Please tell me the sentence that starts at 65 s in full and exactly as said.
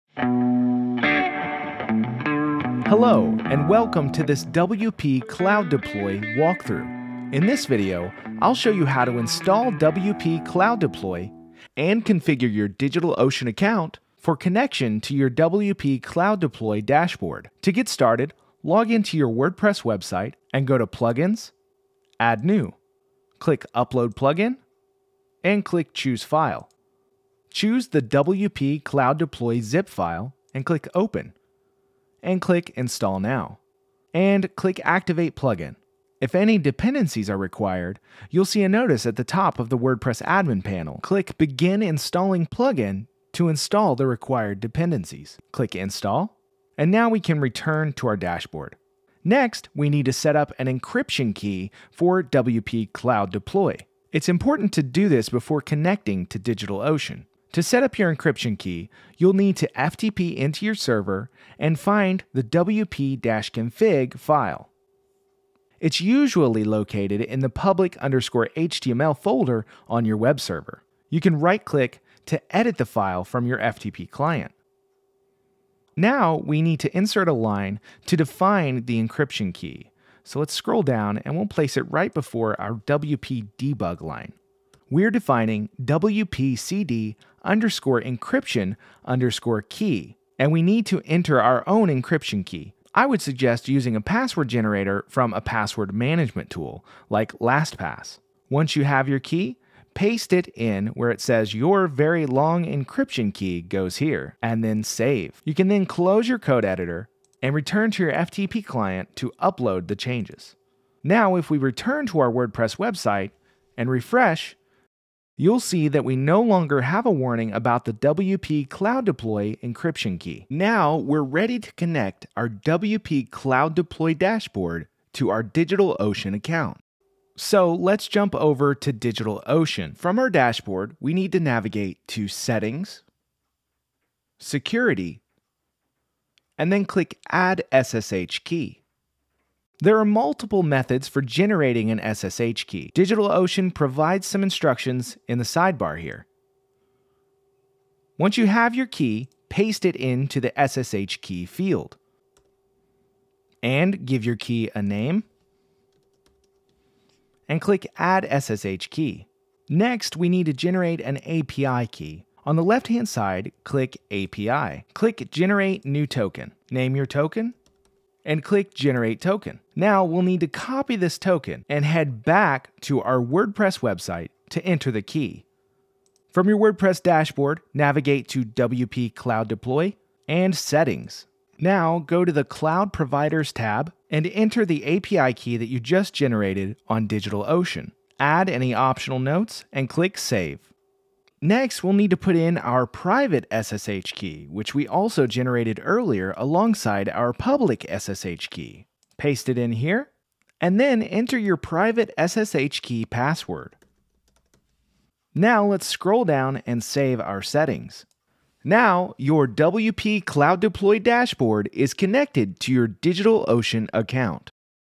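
It's usually located in the public underscore HTML folder on your web server.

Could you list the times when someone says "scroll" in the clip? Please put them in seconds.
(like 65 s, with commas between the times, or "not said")
80 s, 205 s.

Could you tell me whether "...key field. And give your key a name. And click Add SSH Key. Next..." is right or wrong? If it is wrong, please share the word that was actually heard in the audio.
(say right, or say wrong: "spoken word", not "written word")
right.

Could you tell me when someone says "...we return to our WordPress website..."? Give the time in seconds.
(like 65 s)
111 s.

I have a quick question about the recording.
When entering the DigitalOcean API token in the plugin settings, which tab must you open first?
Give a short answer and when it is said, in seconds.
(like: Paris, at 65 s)
Cloud Providers, at 182 s.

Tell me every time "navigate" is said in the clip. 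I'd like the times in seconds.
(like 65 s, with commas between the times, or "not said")
131 s, 177 s.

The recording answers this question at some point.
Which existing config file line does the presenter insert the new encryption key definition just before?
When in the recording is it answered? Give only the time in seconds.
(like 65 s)
82 s.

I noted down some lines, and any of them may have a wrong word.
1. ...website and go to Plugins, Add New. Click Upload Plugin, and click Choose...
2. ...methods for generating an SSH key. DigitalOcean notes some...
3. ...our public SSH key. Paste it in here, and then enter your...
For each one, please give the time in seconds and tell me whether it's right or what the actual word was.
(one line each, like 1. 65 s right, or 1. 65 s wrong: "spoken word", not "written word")
1. 19 s right
2. 140 s wrong: "provides", not "notes"
3. 197 s right.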